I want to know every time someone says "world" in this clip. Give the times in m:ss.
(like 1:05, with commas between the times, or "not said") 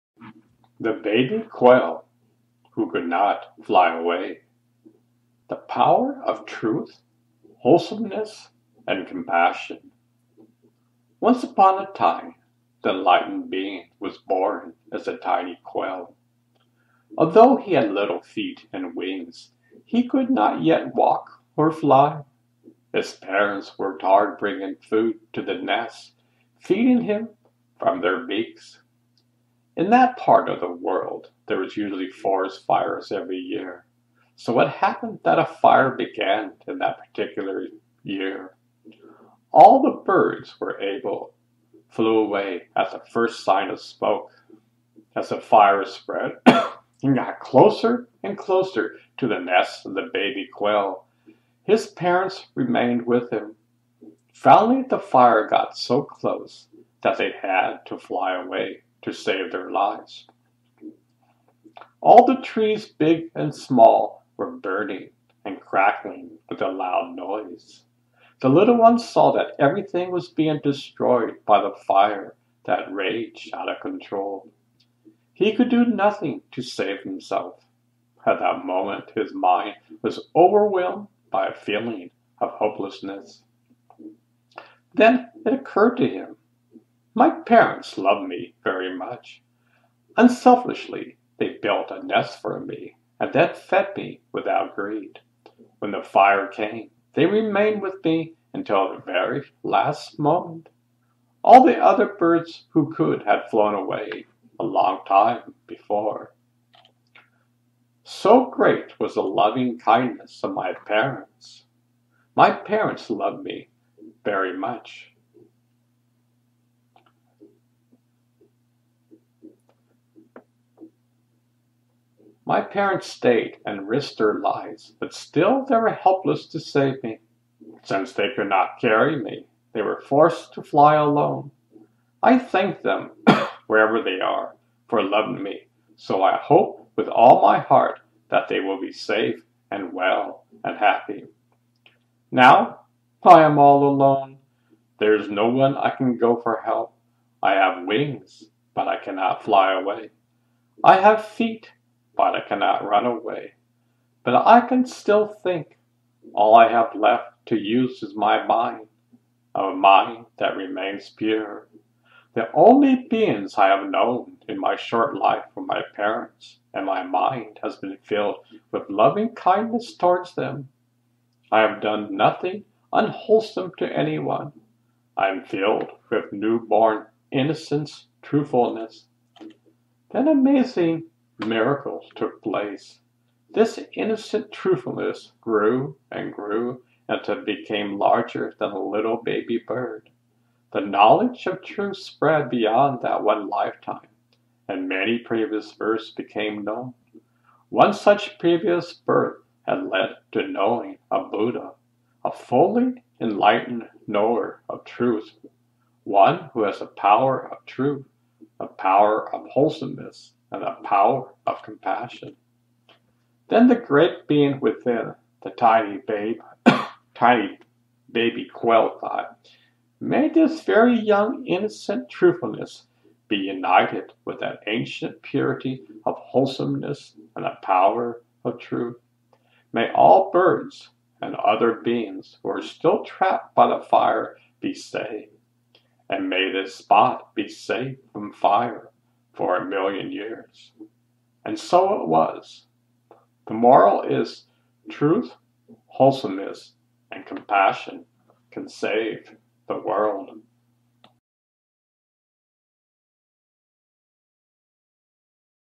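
0:30, 4:09.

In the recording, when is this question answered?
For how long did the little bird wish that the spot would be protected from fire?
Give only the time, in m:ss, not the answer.
3:59.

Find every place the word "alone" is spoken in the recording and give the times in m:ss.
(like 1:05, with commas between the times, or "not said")
2:10, 2:23.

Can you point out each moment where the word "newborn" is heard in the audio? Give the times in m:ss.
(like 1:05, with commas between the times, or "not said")
2:56.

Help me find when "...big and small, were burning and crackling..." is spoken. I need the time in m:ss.
1:02.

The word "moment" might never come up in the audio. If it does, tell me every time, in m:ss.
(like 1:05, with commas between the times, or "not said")
1:18, 1:40.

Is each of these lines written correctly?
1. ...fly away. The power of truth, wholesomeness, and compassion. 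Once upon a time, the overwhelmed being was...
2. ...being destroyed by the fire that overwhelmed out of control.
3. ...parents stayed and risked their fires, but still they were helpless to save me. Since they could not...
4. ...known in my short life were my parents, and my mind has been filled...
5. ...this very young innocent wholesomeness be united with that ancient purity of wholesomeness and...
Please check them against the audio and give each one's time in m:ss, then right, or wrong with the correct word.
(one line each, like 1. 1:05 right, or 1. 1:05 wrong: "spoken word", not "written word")
1. 0:03 wrong: "enlightened", not "overwhelmed"
2. 1:10 wrong: "raged", not "overwhelmed"
3. 2:02 wrong: "lives", not "fires"
4. 2:43 right
5. 3:40 wrong: "truthfulness", not "wholesomeness".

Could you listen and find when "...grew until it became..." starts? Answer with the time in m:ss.
3:06.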